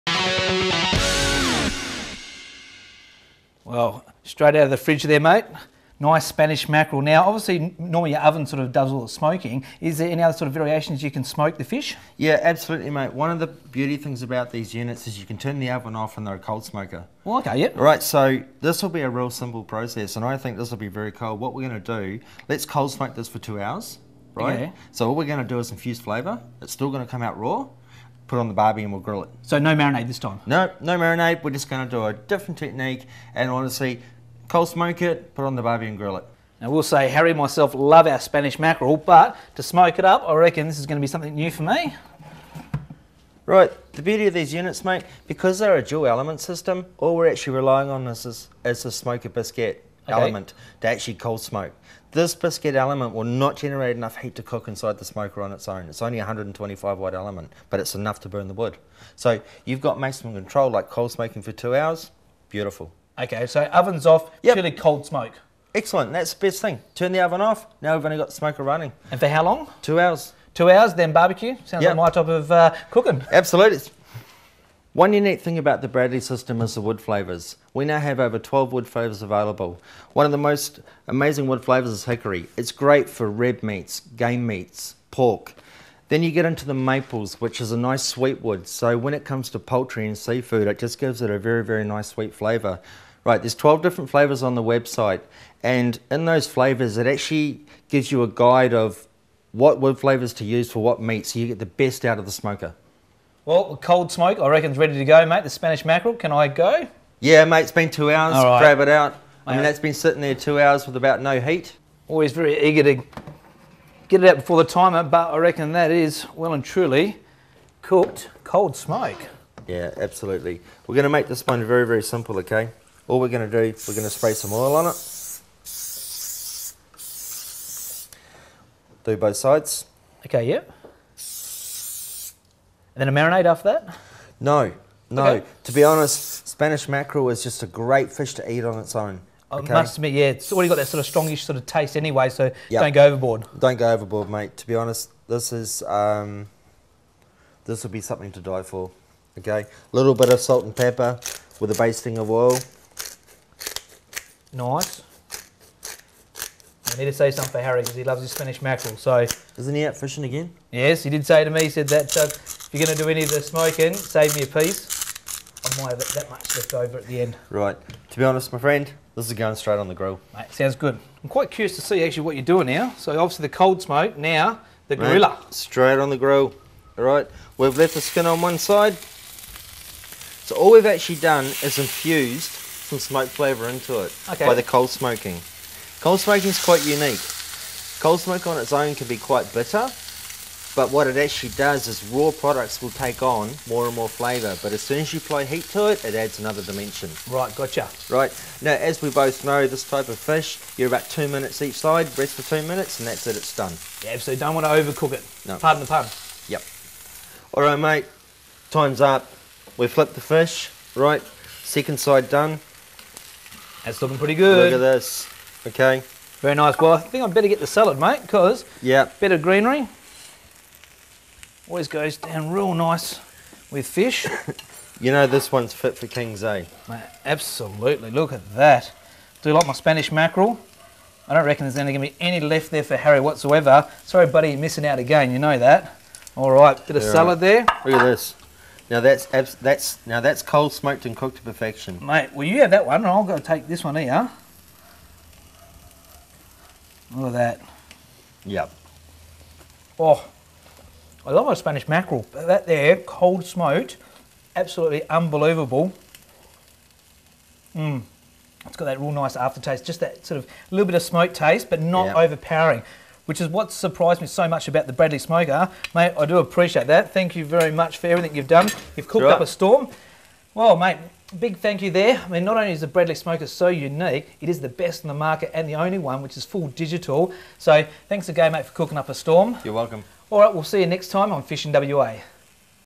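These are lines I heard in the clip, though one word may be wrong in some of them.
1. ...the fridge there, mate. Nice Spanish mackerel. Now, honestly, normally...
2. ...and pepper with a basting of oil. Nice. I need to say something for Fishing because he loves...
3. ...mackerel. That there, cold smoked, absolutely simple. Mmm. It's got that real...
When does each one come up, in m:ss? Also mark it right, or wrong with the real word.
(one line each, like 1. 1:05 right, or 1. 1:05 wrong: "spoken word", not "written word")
1. 0:04 wrong: "obviously", not "honestly"
2. 2:30 wrong: "Harry", not "Fishing"
3. 4:11 wrong: "unbelievable", not "simple".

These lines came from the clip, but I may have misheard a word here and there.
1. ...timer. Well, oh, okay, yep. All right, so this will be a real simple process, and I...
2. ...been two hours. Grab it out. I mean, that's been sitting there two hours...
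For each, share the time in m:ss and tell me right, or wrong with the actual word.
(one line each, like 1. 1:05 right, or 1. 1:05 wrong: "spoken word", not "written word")
1. 0:16 wrong: "smoker", not "timer"
2. 1:47 right.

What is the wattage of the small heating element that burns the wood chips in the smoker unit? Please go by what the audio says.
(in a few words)
125 watts.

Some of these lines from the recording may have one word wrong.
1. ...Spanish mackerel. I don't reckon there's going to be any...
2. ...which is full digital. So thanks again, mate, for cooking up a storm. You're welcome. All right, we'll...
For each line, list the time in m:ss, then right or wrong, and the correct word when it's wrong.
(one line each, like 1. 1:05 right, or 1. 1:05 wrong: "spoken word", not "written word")
1. 3:49 right
2. 4:36 right.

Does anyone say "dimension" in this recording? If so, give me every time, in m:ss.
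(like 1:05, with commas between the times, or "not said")
3:16.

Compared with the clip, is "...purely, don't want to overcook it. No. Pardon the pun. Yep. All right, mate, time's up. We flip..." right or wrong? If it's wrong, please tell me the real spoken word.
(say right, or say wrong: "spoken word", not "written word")
wrong: "absolutely", not "purely".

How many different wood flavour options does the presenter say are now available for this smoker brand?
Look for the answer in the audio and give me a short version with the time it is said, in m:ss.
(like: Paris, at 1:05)
12, at 1:18.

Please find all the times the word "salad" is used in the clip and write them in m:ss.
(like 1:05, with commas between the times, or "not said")
3:37, 3:57.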